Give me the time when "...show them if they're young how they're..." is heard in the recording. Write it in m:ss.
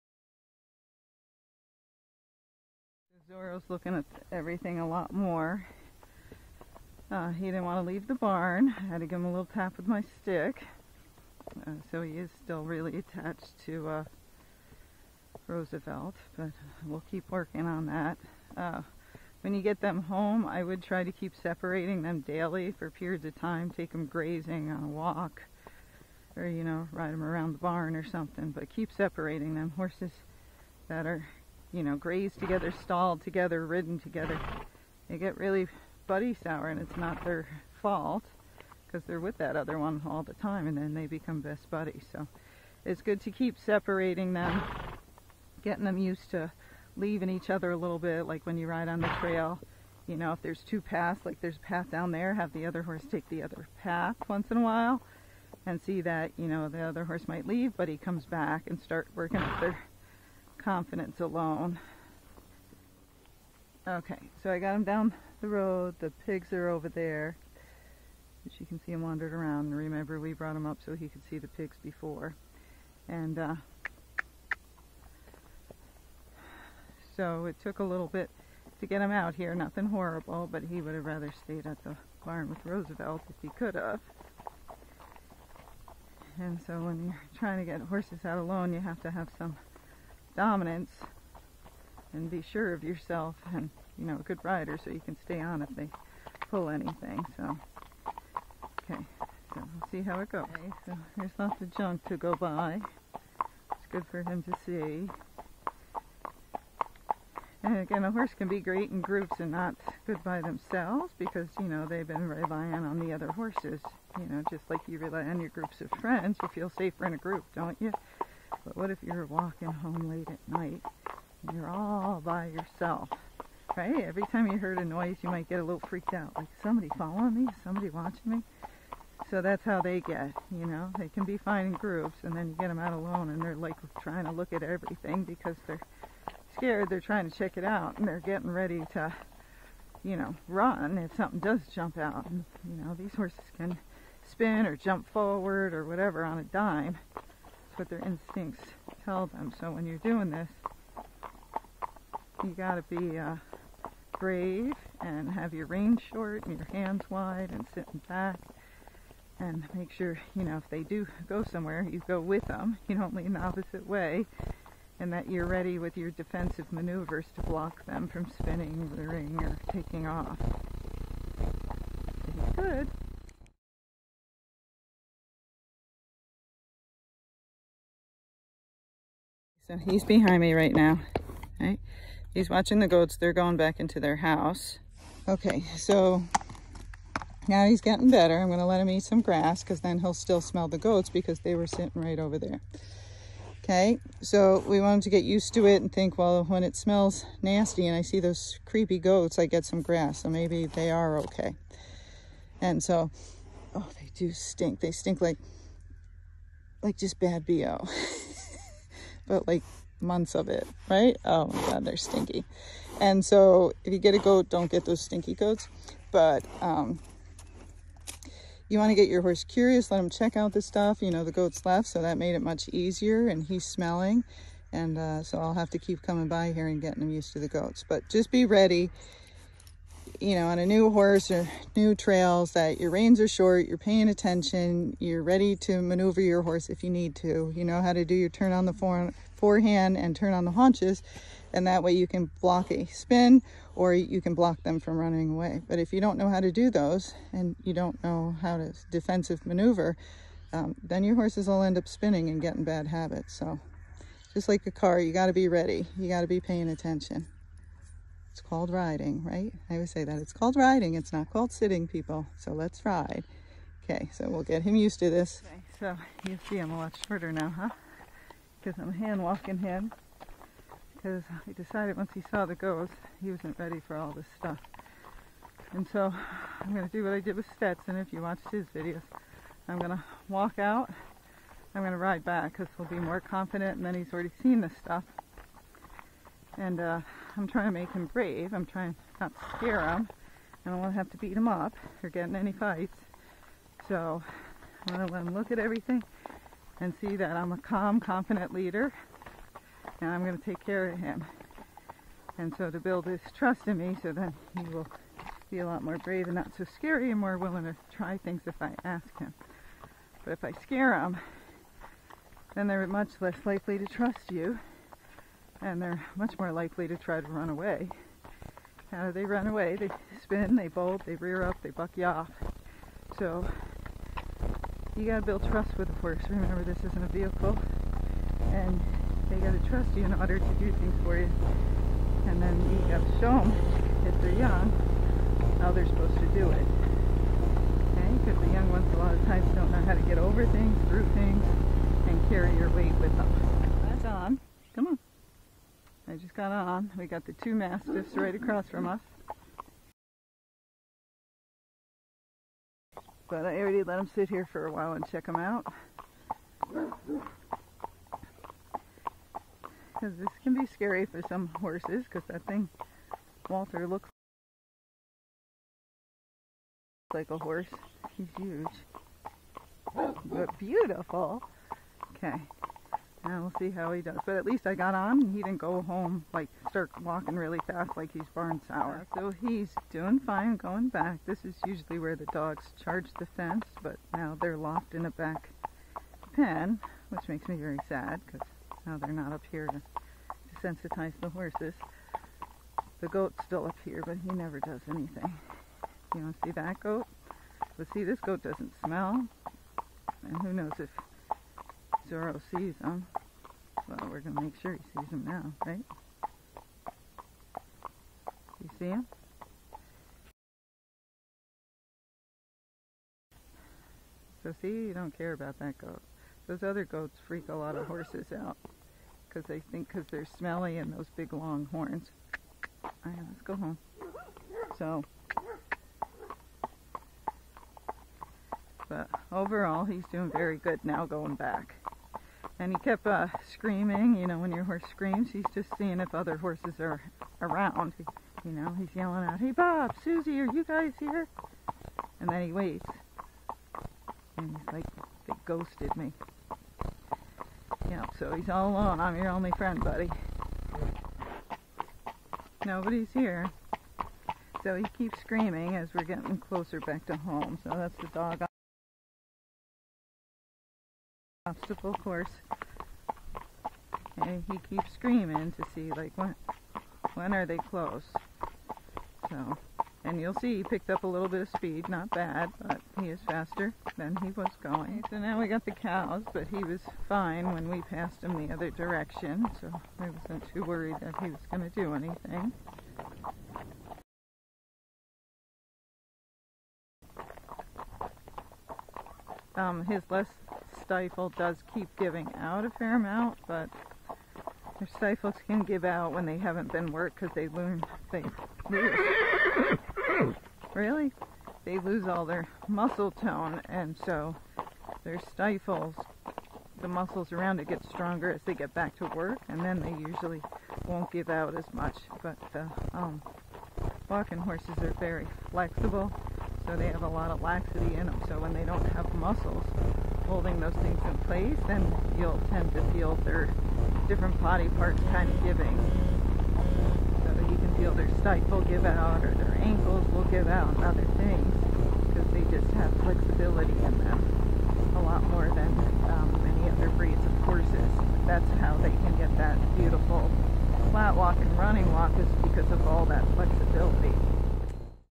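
5:33.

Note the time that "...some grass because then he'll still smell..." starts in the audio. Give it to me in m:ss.
3:09.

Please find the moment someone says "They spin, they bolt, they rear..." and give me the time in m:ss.
5:19.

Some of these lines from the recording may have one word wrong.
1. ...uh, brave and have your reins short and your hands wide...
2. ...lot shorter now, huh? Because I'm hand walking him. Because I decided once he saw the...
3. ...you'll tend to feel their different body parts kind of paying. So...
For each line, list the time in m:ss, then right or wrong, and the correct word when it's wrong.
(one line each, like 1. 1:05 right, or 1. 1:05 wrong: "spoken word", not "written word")
1. 2:33 right
2. 4:26 right
3. 8:42 wrong: "giving", not "paying".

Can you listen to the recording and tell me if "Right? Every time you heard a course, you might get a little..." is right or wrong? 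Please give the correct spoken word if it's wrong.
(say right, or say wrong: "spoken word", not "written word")
wrong: "noise", not "course".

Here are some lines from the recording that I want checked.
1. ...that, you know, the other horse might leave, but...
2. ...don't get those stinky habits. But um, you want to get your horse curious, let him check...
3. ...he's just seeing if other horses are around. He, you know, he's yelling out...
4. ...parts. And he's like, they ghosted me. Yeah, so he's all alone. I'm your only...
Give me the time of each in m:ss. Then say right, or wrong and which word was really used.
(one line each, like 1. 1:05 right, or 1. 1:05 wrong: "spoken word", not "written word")
1. 0:56 right
2. 3:34 wrong: "goats", not "habits"
3. 7:15 right
4. 7:22 wrong: "waits", not "parts".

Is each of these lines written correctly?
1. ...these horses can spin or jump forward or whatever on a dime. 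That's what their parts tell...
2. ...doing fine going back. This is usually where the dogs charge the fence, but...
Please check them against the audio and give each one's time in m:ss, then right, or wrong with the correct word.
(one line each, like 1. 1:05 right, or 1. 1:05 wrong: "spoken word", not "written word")
1. 2:22 wrong: "instincts", not "parts"
2. 6:19 right.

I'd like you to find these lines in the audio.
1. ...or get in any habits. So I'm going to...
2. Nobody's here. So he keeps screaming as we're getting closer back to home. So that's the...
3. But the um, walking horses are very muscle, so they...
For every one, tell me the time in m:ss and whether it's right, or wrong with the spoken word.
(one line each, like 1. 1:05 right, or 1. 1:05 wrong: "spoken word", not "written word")
1. 4:52 wrong: "fights", not "habits"
2. 7:32 right
3. 8:32 wrong: "flexible", not "muscle".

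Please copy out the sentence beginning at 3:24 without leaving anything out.
They stink like, like just bad BO.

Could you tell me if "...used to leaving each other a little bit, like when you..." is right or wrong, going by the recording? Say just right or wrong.
right.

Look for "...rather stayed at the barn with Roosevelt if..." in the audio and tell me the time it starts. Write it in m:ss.
1:21.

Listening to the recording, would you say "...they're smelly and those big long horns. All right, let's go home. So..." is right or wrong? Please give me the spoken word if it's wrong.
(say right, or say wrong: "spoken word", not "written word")
right.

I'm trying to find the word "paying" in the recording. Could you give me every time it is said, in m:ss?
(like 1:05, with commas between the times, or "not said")
3:53, 4:16.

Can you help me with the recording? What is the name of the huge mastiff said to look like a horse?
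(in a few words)
Walter.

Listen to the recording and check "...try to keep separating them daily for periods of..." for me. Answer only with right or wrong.
right.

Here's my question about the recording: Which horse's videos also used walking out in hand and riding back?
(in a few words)
Stetson.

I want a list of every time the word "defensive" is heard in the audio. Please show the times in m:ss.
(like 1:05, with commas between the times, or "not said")
2:46, 4:08.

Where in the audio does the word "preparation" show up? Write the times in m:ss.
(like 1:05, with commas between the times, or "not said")
not said.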